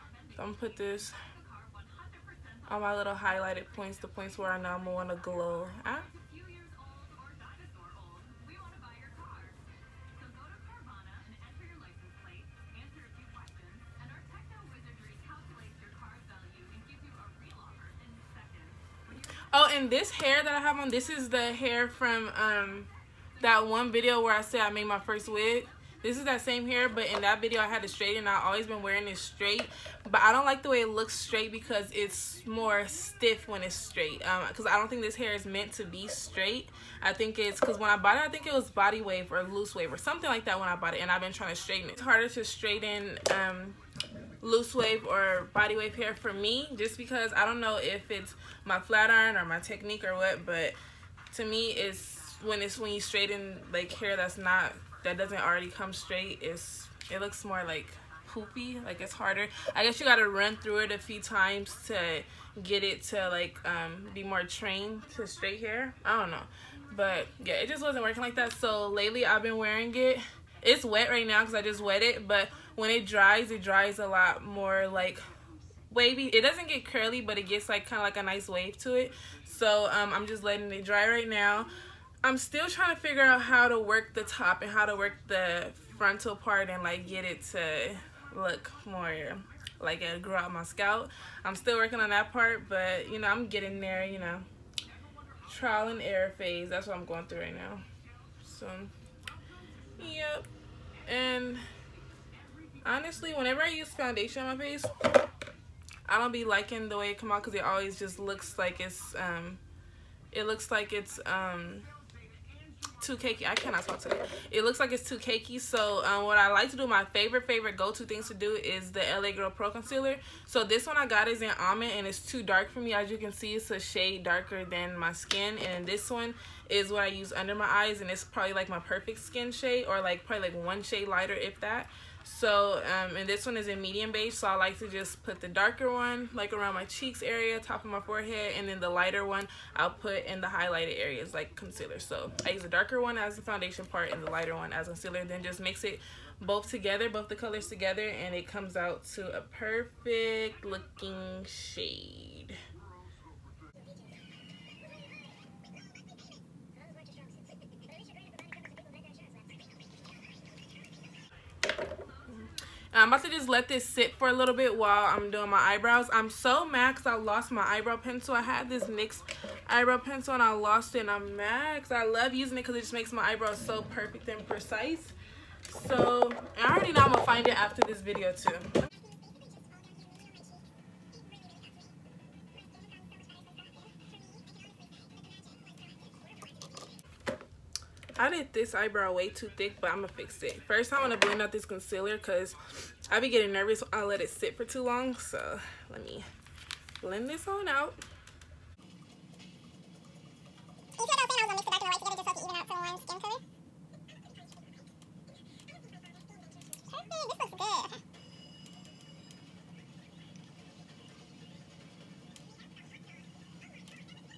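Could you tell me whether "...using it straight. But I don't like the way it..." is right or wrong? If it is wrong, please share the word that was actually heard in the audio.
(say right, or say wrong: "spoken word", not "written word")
wrong: "wearing", not "using".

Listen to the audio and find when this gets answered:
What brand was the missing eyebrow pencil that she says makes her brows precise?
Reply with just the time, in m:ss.
2:48.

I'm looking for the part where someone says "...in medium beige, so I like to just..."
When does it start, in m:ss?
2:13.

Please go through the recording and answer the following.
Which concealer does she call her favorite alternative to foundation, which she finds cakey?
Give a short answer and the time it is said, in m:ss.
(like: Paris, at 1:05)
LA Girl Pro Concealer, at 1:59.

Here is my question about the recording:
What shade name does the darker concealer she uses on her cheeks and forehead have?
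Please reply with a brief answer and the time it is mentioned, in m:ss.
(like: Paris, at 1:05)
Almond, at 2:01.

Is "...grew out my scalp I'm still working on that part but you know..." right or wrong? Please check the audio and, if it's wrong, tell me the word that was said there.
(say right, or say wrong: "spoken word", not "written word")
right.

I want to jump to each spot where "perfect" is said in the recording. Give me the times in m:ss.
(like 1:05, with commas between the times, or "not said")
2:08, 2:29, 2:53.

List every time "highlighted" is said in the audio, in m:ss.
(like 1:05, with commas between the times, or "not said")
0:03, 2:20.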